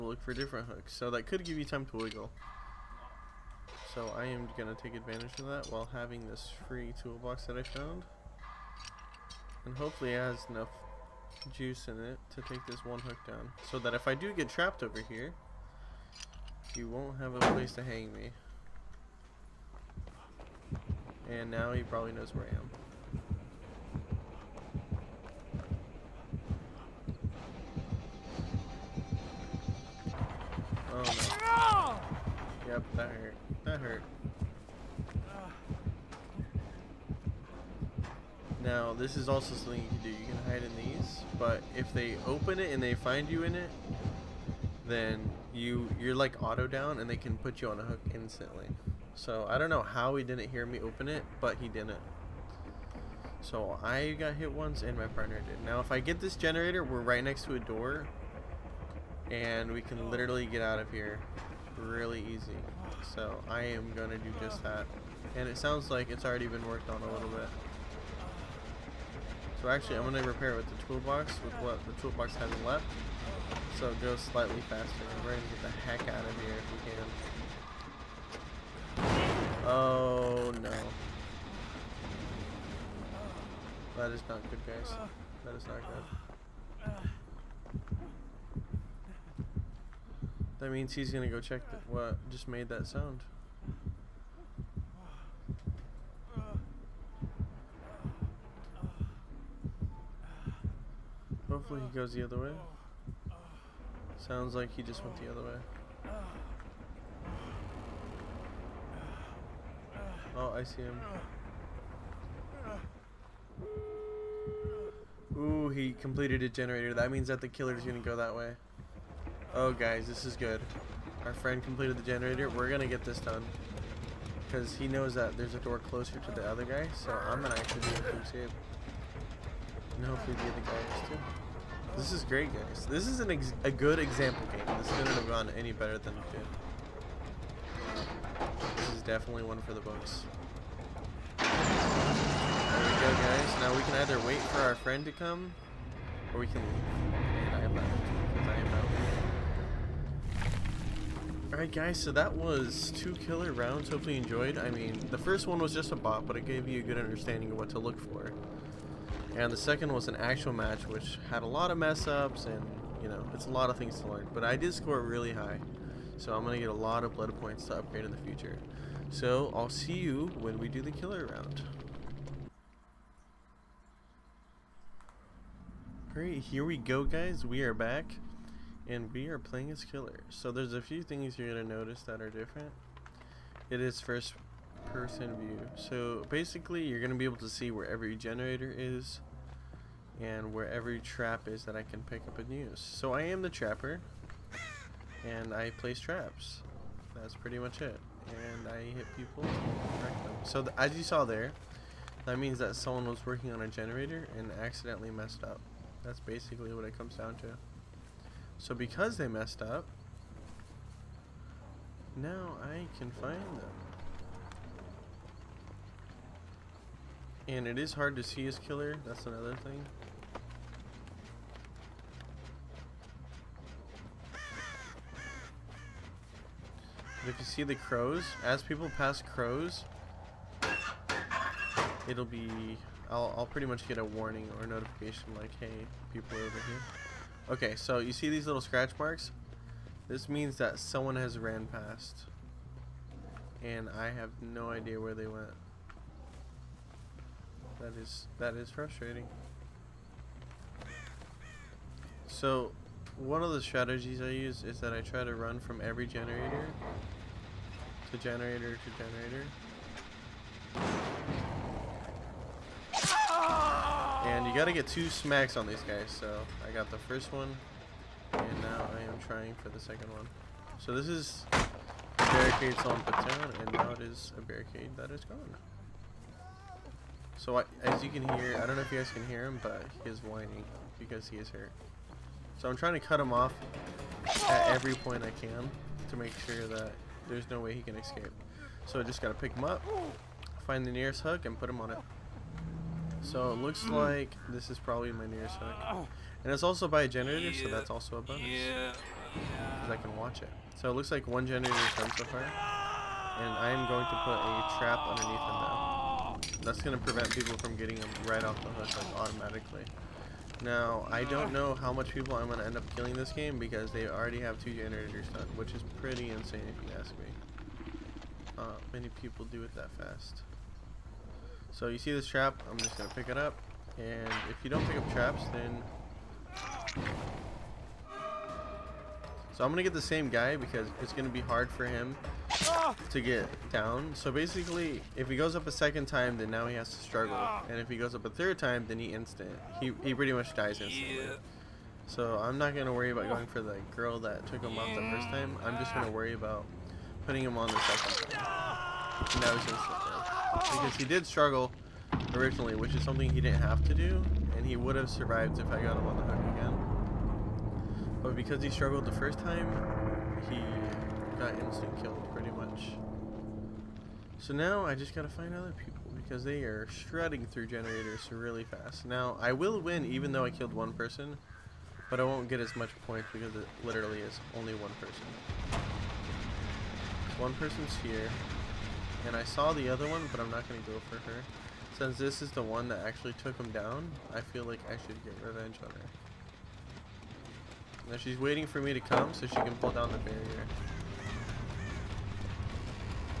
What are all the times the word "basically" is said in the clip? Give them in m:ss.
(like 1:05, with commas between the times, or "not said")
3:06, 3:26, 5:34.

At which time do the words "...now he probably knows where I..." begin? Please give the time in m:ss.
0:21.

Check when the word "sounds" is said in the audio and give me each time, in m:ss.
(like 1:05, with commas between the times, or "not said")
1:05, 1:32, 1:44.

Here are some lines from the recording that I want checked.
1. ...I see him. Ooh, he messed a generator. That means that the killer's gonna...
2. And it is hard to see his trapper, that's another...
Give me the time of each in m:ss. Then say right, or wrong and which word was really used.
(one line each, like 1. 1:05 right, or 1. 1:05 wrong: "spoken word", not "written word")
1. 1:50 wrong: "completed", not "messed"
2. 3:37 wrong: "killer", not "trapper".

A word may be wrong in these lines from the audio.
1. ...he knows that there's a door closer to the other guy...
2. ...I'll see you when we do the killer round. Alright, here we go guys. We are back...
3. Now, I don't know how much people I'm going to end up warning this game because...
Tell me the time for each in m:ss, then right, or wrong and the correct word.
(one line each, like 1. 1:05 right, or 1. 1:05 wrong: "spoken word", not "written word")
1. 2:04 right
2. 2:49 right
3. 5:10 wrong: "killing", not "warning".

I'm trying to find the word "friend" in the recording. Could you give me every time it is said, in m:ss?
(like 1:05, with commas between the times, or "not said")
2:01, 2:24.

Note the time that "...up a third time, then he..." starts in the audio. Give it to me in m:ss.
5:38.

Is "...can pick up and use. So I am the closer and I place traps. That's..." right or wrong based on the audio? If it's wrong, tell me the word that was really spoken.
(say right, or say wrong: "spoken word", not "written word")
wrong: "trapper", not "closer".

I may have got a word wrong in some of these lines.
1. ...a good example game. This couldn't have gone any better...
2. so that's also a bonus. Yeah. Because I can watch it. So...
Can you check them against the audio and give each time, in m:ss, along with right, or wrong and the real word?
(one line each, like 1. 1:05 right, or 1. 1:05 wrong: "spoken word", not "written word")
1. 2:13 right
2. 4:57 right.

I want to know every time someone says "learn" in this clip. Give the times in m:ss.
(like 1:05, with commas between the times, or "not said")
2:44.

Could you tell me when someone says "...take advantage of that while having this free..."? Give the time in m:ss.
0:04.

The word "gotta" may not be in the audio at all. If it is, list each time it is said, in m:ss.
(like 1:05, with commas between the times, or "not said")
4:24, 4:49, 6:05.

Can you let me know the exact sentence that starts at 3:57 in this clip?
Okay, so you see these little scratch marks?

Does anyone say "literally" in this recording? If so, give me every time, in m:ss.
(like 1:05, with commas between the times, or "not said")
1:00, 6:13.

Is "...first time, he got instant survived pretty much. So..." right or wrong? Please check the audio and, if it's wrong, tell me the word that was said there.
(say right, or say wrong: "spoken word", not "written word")
wrong: "killed", not "survived".